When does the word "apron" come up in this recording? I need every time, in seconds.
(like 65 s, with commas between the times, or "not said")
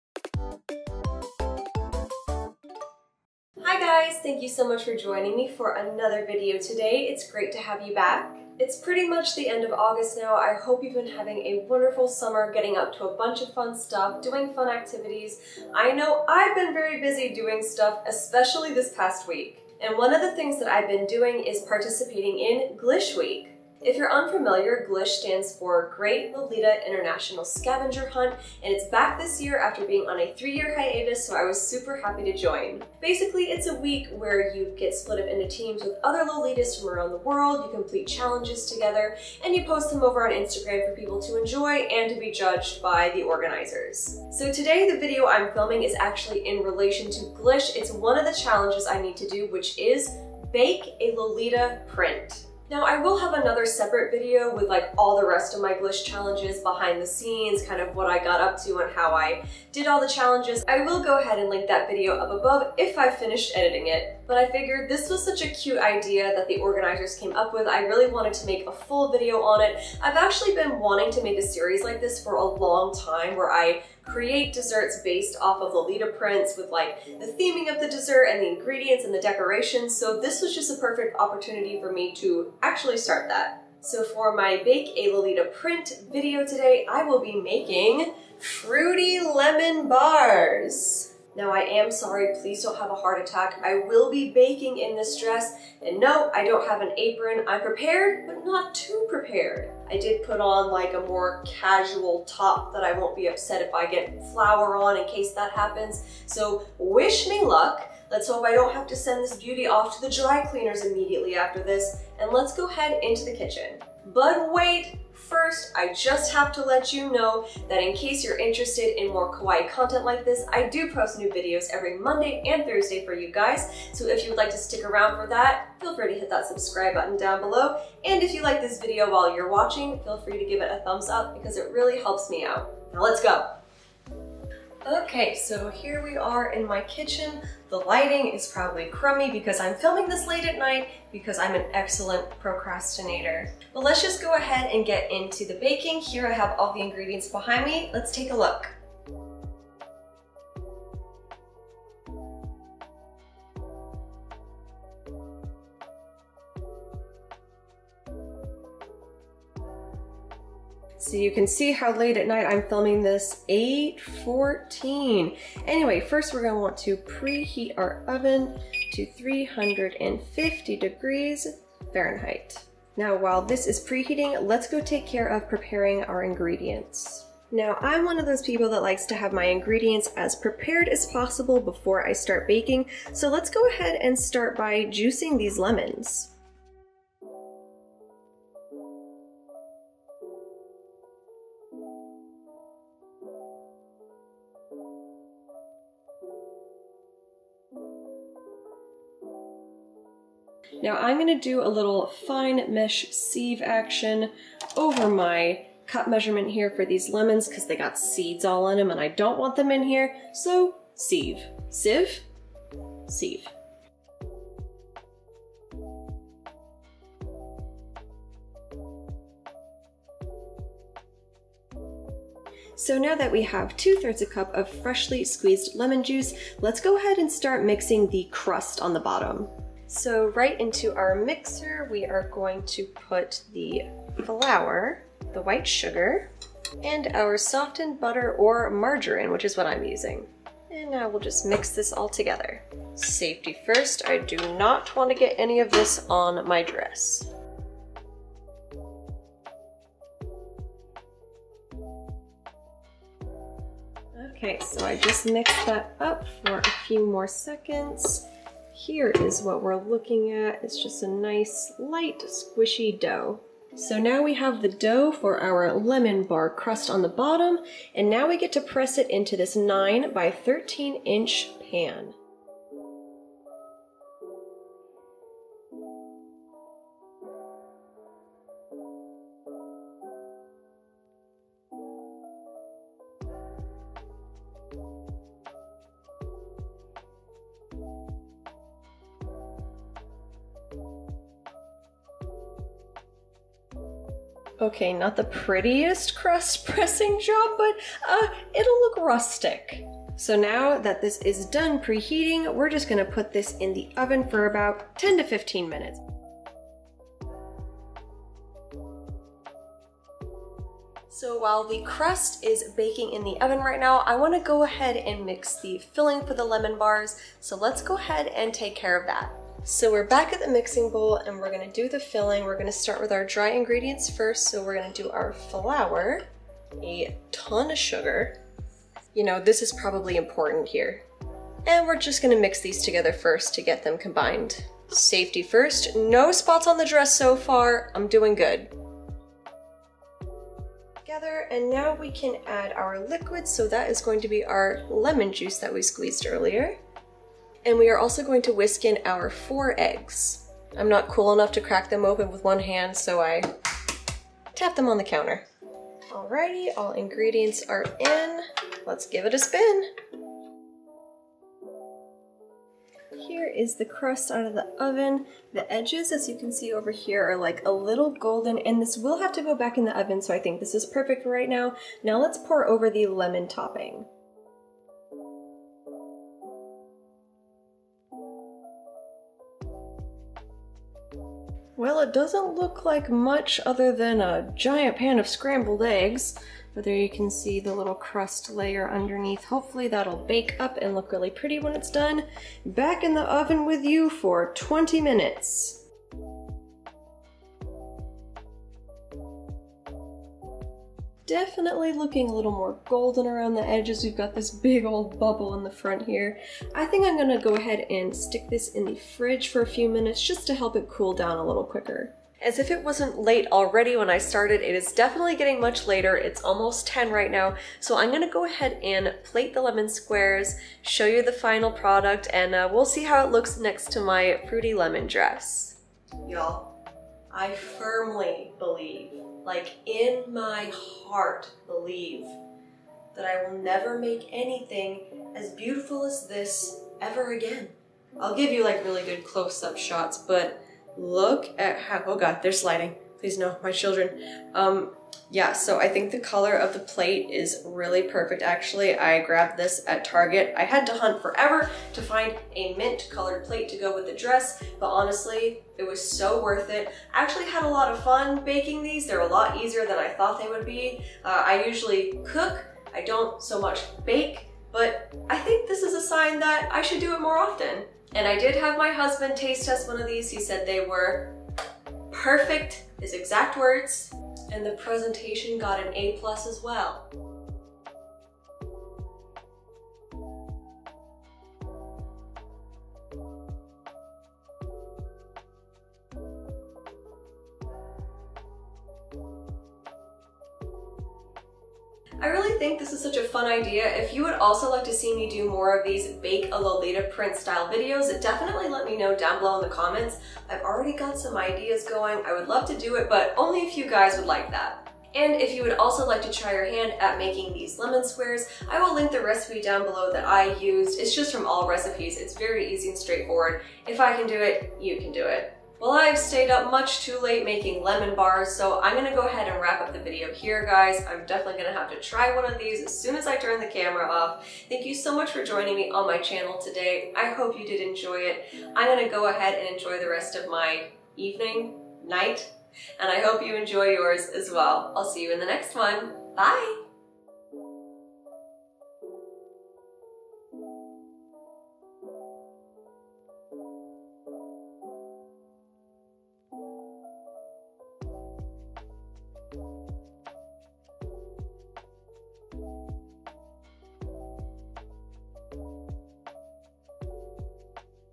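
96 s.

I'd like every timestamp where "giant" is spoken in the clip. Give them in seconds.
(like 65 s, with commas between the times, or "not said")
384 s.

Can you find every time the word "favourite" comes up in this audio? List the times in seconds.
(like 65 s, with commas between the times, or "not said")
not said.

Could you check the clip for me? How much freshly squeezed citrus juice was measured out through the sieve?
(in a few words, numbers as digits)
2/3 cup.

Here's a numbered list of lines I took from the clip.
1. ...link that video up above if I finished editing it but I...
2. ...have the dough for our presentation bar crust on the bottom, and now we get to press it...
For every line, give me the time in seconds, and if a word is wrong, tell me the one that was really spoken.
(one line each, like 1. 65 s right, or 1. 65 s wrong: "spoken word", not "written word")
1. 61 s right
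2. 264 s wrong: "lemon", not "presentation".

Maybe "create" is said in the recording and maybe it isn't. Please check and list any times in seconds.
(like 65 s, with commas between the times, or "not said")
74 s.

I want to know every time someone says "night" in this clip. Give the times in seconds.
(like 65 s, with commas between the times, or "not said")
140 s, 162 s, 532 s.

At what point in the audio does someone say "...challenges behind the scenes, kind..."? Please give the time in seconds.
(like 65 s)
56 s.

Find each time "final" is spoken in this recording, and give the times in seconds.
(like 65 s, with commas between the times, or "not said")
421 s.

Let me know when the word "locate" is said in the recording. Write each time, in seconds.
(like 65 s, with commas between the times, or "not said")
not said.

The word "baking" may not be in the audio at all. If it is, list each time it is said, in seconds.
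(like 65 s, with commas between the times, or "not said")
94 s, 145 s, 182 s, 312 s, 458 s.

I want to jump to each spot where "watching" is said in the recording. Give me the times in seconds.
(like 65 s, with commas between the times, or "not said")
129 s.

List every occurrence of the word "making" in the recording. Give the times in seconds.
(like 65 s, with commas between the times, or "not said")
87 s, 507 s, 517 s.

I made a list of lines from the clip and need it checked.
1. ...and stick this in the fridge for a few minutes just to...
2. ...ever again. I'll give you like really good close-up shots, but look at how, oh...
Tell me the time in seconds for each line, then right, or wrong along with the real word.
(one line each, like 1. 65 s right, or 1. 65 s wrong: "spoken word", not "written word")
1. 407 s right
2. 437 s right.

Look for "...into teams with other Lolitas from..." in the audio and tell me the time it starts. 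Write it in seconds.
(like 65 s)
35 s.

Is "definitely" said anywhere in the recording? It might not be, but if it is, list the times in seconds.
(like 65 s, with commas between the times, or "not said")
401 s, 414 s, 498 s, 521 s.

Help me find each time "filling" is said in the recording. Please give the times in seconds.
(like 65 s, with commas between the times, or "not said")
315 s, 321 s.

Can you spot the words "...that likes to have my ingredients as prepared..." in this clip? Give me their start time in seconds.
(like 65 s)
178 s.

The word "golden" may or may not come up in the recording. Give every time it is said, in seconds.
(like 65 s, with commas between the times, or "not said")
368 s, 402 s.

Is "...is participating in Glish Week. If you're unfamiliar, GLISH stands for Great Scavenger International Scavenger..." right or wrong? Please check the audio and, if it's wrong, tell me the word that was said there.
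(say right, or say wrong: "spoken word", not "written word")
wrong: "Lolita", not "Scavenger".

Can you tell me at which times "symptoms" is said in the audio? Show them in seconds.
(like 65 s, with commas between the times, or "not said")
not said.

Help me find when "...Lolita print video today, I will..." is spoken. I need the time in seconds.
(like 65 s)
85 s.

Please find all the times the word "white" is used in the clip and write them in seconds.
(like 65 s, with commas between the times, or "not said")
235 s.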